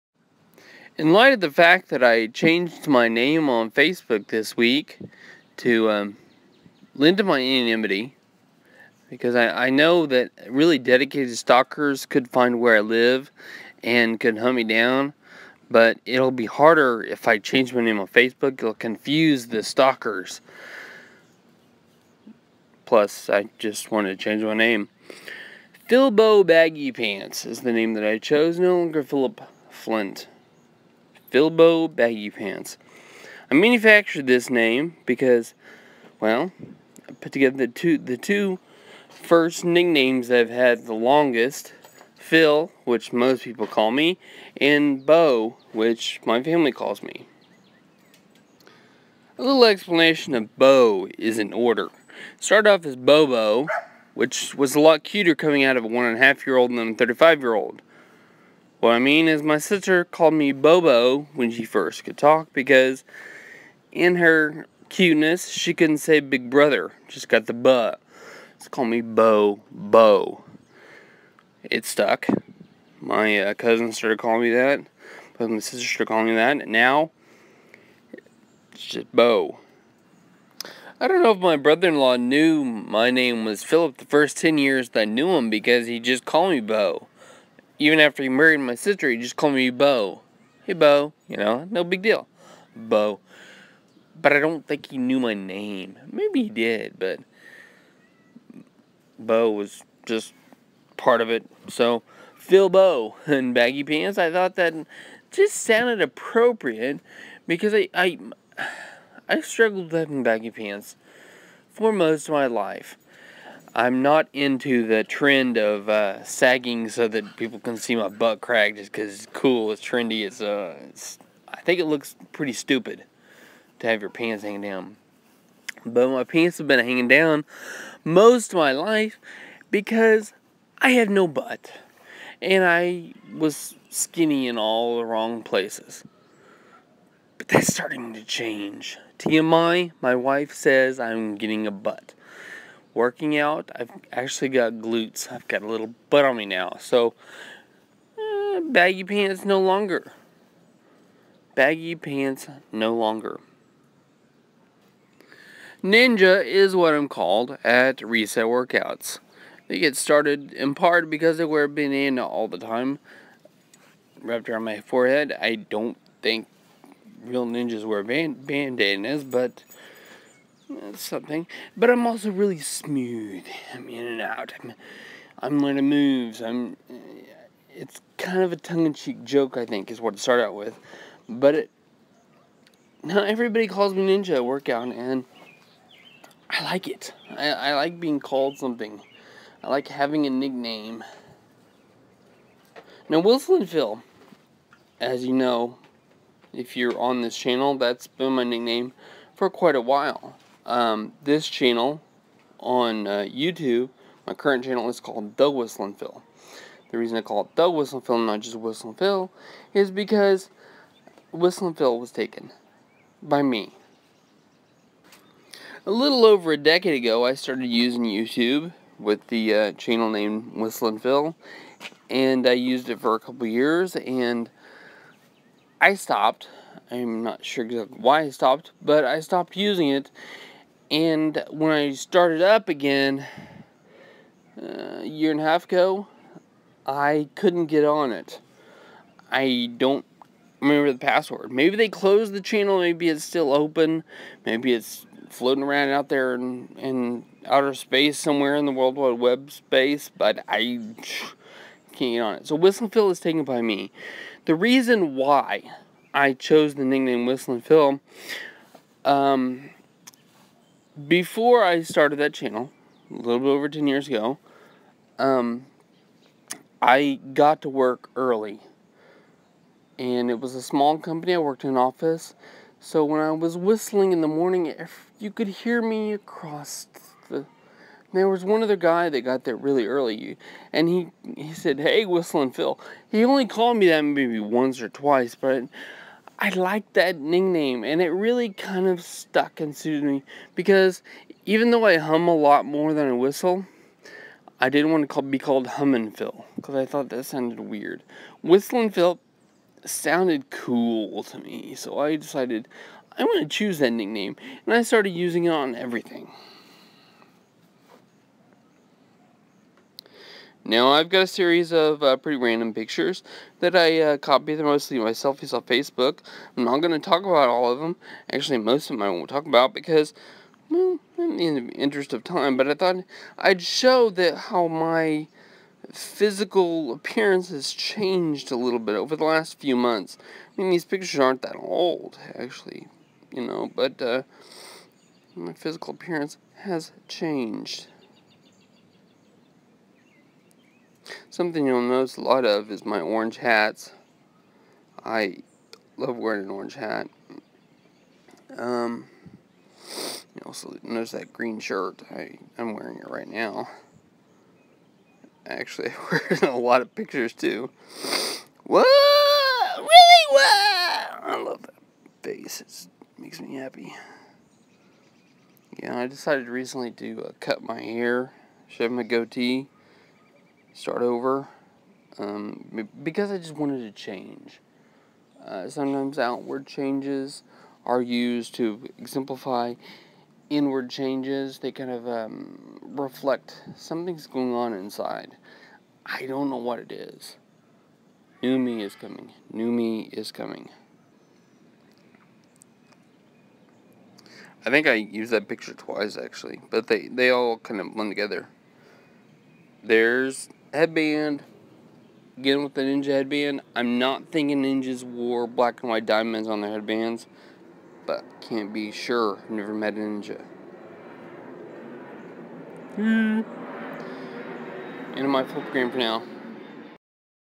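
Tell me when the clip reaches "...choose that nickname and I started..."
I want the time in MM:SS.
05:03.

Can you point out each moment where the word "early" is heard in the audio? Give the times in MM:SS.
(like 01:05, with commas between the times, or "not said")
04:28, 04:39.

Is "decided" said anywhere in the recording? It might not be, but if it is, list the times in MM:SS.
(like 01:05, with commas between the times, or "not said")
05:02, 06:06.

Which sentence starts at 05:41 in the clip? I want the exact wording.
Something you'll notice a lot of is my orange hats.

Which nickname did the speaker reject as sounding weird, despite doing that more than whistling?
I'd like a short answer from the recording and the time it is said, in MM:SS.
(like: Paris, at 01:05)
Hummin' Phil, at 04:55.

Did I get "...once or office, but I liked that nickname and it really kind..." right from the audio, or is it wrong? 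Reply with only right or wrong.
wrong.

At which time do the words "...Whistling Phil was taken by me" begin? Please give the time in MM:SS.
03:31.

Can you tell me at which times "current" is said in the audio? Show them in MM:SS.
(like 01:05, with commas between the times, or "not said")
03:24.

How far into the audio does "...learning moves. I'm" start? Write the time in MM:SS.
02:55.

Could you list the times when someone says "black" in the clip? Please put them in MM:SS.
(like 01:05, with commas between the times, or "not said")
06:45.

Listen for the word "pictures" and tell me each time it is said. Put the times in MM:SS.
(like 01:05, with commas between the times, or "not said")
05:12, 05:30, 05:56, 06:35.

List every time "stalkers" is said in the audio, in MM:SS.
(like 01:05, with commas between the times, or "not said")
00:11, 00:19.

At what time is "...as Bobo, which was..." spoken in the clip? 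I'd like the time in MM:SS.
00:52.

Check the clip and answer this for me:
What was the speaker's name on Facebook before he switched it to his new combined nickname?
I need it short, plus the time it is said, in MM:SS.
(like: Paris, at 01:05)
Philip Flynt, at 00:29.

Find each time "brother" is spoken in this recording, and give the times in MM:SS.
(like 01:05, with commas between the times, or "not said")
01:06, 01:21.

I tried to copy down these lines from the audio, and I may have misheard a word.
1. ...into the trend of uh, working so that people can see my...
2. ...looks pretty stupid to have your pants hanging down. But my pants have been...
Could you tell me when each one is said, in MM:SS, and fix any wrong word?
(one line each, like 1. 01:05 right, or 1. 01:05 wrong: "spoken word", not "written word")
1. 01:54 wrong: "sagging", not "working"
2. 02:01 right.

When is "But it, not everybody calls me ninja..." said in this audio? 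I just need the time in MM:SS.
03:01.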